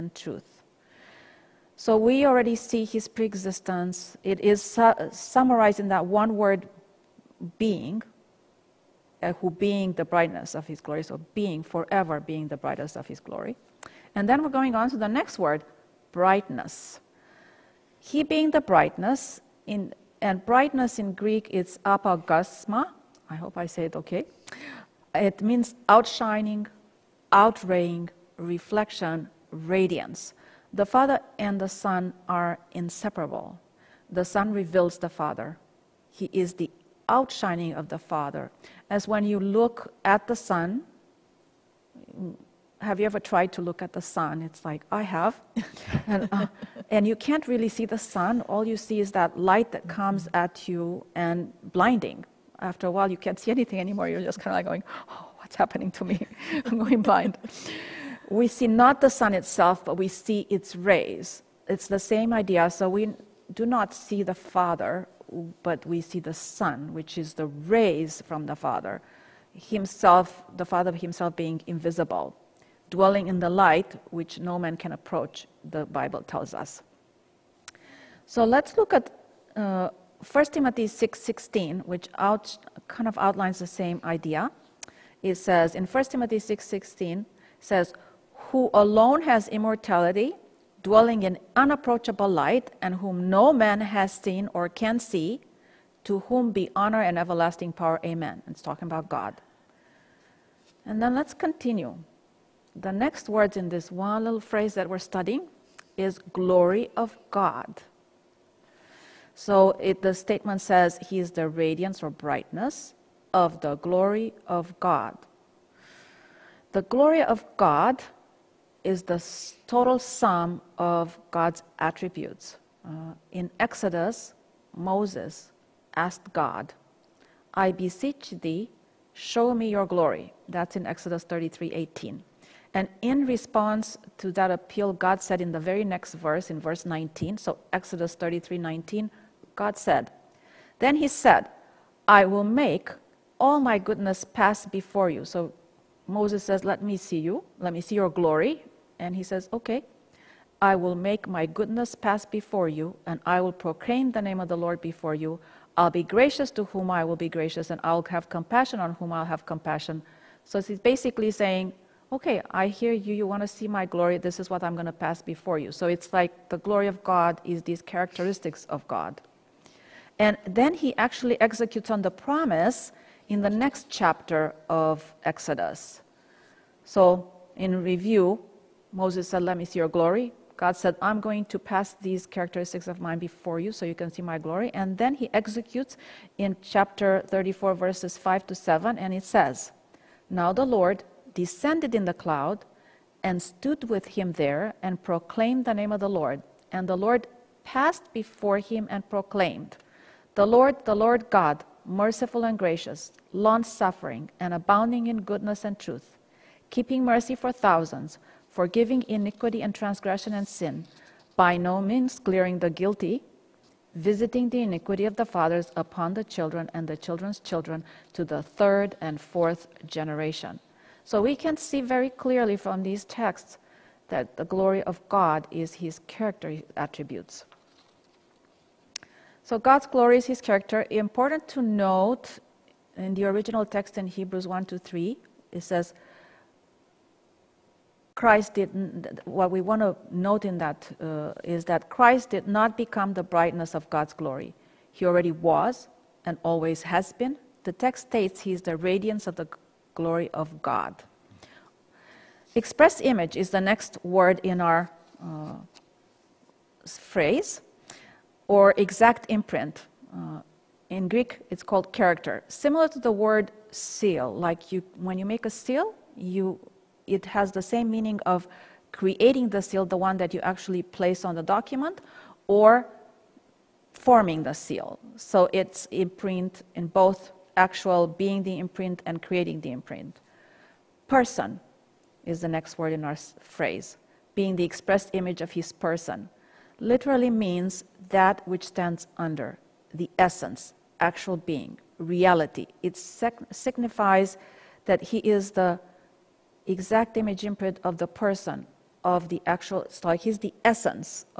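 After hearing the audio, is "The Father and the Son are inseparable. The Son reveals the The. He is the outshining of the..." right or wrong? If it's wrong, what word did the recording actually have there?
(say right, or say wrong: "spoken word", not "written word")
wrong: "Father", not "The".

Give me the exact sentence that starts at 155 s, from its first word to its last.
I'll be gracious to whom I will be gracious, and I'll have compassion on whom I'll have compassion.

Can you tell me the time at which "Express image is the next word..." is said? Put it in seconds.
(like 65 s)
252 s.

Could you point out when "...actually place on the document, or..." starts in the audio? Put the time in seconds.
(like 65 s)
270 s.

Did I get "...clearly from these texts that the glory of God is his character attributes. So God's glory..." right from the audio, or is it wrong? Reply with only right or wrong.
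right.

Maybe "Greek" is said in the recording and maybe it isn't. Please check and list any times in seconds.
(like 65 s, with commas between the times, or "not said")
21 s, 261 s.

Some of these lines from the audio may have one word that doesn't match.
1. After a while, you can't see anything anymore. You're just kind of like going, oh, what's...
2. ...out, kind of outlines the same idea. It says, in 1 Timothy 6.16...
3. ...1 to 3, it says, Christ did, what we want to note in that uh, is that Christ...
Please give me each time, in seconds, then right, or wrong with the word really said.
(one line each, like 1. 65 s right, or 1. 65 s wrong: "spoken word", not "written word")
1. 52 s right
2. 82 s right
3. 234 s right.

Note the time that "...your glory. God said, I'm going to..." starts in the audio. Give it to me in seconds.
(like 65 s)
179 s.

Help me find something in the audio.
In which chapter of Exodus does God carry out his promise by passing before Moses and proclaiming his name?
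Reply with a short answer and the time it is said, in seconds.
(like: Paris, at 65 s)
chapter 34, at 186 s.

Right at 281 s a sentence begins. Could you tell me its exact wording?
Person is the next word in our phrase, being the expressed image of his person.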